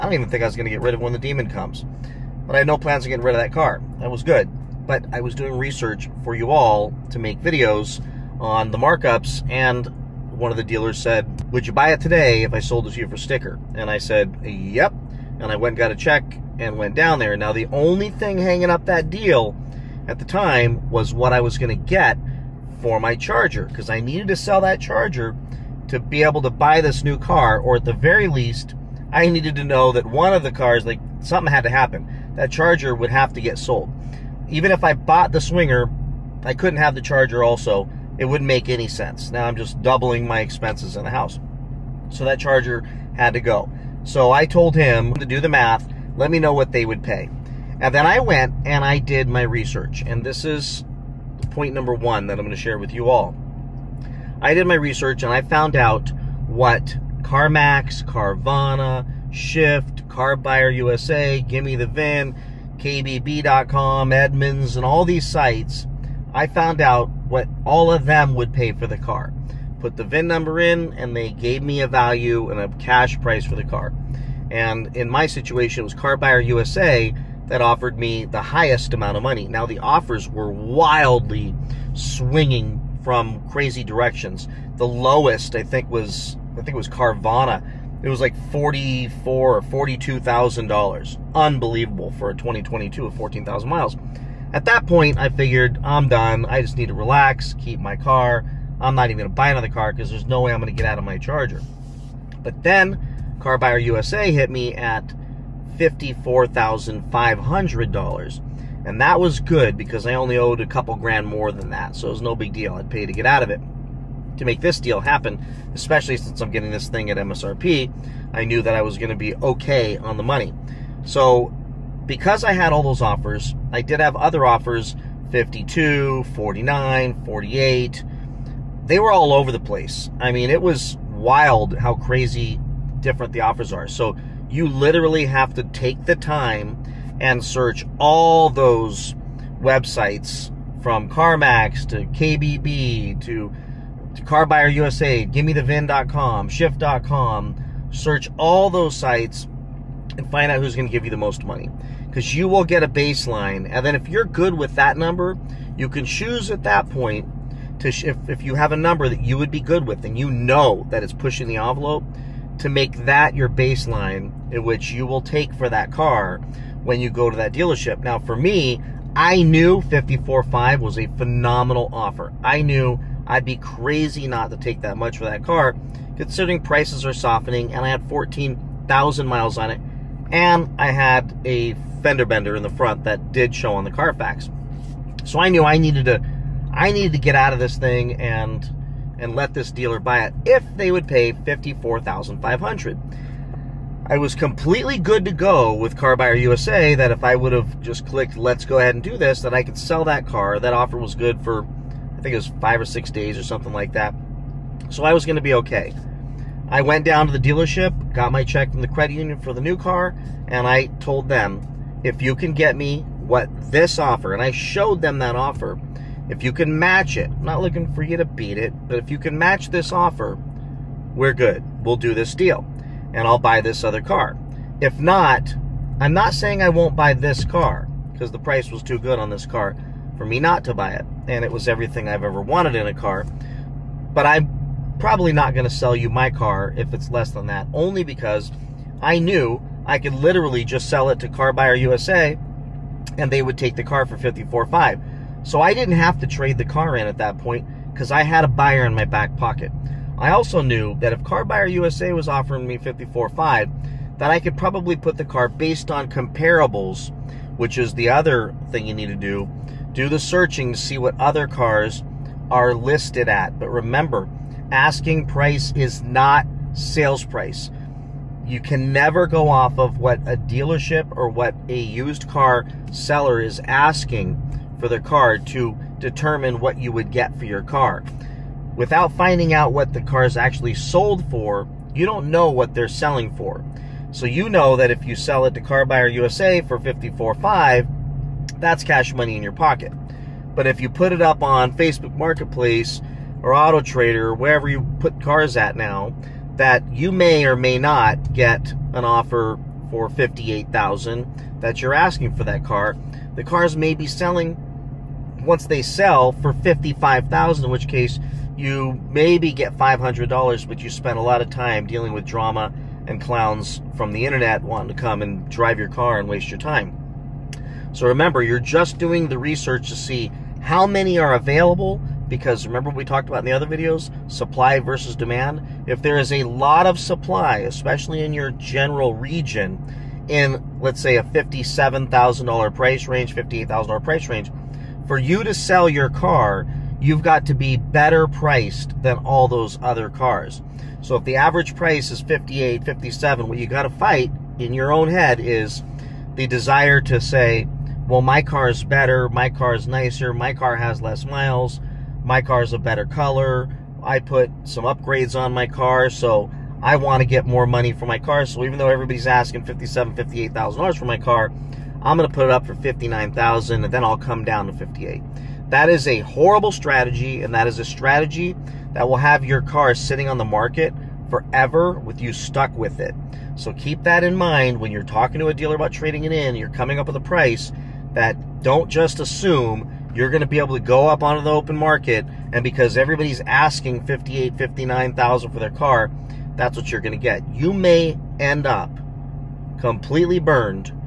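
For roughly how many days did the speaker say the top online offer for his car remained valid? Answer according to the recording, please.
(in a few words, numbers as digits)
5 or 6 days.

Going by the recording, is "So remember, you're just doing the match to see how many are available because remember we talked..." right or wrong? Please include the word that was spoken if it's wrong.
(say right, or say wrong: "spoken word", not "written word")
wrong: "research", not "match".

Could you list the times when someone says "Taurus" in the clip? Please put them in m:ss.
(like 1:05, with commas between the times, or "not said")
not said.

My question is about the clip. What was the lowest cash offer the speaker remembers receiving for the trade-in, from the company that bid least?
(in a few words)
$44,000.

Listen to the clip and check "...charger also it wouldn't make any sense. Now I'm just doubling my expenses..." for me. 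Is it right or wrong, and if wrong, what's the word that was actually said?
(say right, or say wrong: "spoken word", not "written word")
right.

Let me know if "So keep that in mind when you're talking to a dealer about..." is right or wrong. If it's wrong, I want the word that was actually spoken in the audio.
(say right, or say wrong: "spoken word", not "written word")
right.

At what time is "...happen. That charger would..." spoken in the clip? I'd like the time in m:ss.
0:31.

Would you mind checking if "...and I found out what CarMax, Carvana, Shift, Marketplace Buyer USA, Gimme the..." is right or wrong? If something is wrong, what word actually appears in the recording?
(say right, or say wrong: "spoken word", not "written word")
wrong: "Car", not "Marketplace".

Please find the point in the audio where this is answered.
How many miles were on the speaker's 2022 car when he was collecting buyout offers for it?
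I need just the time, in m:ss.
1:33.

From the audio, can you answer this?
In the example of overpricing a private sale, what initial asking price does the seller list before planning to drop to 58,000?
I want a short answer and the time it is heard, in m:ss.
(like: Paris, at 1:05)
$59,000, at 6:02.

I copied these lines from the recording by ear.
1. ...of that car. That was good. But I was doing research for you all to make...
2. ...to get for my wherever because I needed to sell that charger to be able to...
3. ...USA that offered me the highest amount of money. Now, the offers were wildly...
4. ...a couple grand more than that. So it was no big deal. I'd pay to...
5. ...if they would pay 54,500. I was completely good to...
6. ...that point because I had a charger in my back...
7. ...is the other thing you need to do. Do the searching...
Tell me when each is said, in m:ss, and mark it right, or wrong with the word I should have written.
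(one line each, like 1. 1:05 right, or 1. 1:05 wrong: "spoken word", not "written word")
1. 0:03 right
2. 0:21 wrong: "charger", not "wherever"
3. 1:16 right
4. 1:50 right
5. 3:10 right
6. 4:07 wrong: "buyer", not "charger"
7. 4:17 right.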